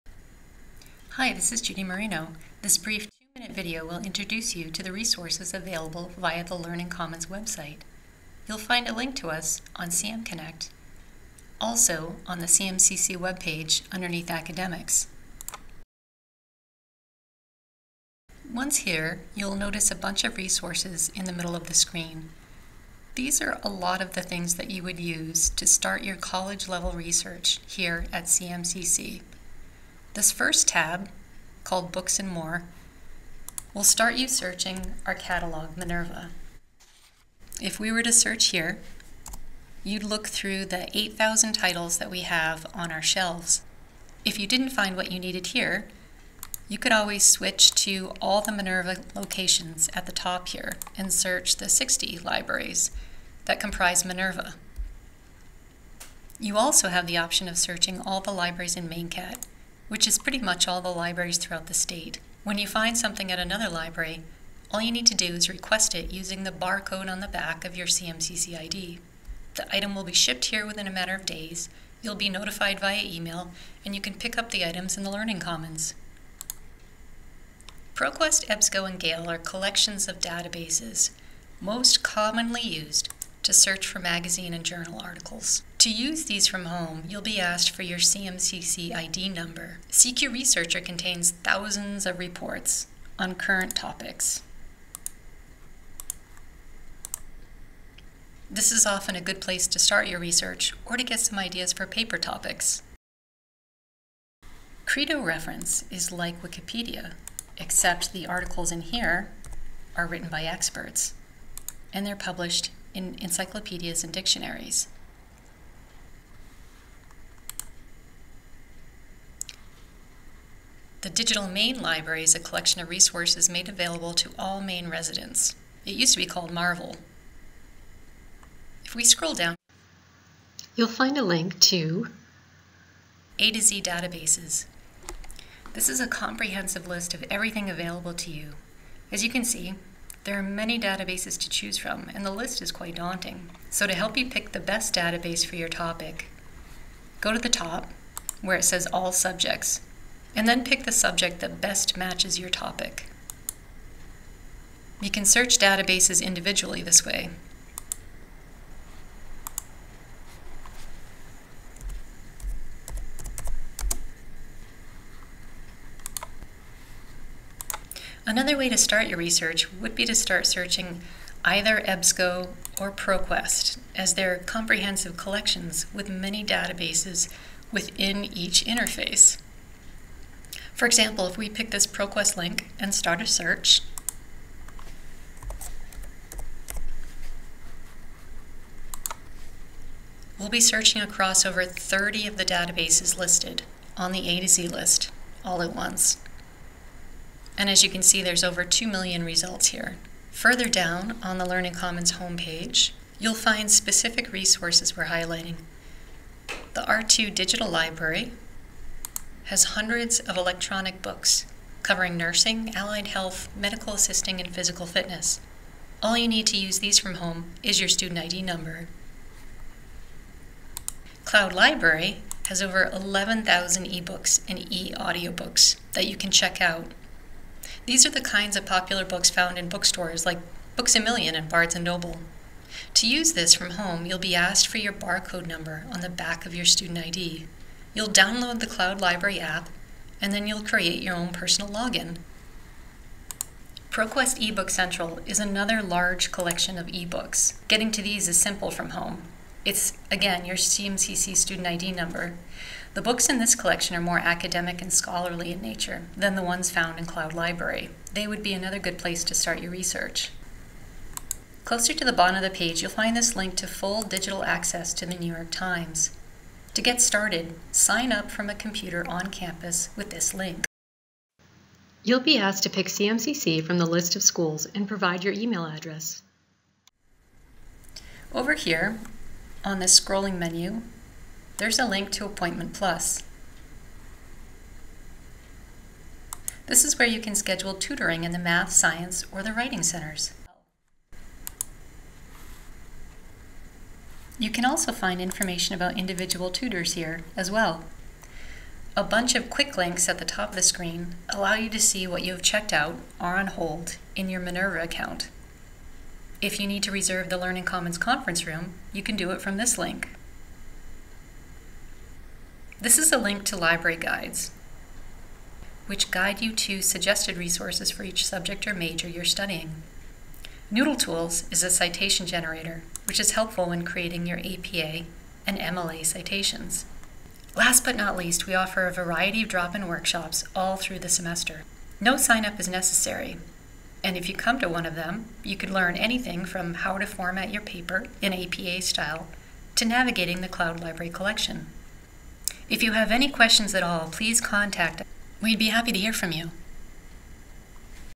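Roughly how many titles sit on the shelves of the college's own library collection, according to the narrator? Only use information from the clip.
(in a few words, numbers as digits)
8,000.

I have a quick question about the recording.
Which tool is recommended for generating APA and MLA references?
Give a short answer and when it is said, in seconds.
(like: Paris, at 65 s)
Noodle Tools, at 320 s.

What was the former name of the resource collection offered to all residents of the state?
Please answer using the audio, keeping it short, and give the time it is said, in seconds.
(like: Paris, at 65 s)
Marvel, at 126 s.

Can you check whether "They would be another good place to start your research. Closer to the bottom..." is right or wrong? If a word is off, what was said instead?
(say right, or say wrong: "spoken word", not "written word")
right.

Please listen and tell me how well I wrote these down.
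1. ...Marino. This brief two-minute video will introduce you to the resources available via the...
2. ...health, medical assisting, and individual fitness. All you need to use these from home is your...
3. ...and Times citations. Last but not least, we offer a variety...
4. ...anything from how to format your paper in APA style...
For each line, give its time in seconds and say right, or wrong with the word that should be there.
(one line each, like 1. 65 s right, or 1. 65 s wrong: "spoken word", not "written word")
1. 1 s right
2. 213 s wrong: "physical", not "individual"
3. 325 s wrong: "MLA", not "Times"
4. 335 s right.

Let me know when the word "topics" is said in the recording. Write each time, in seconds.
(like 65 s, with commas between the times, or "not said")
93 s, 102 s, 145 s, 152 s.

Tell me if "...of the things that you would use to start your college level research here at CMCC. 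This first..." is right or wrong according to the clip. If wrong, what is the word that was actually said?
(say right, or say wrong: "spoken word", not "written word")
right.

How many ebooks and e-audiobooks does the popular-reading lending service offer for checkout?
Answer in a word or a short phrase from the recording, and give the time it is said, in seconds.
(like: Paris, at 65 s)
over 11,000, at 222 s.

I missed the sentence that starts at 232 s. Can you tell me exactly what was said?
To use this from home, you'll be asked for your barcode number on the back of your student ID.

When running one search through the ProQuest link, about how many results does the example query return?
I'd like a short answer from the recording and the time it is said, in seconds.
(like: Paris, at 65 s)
over 2 million, at 198 s.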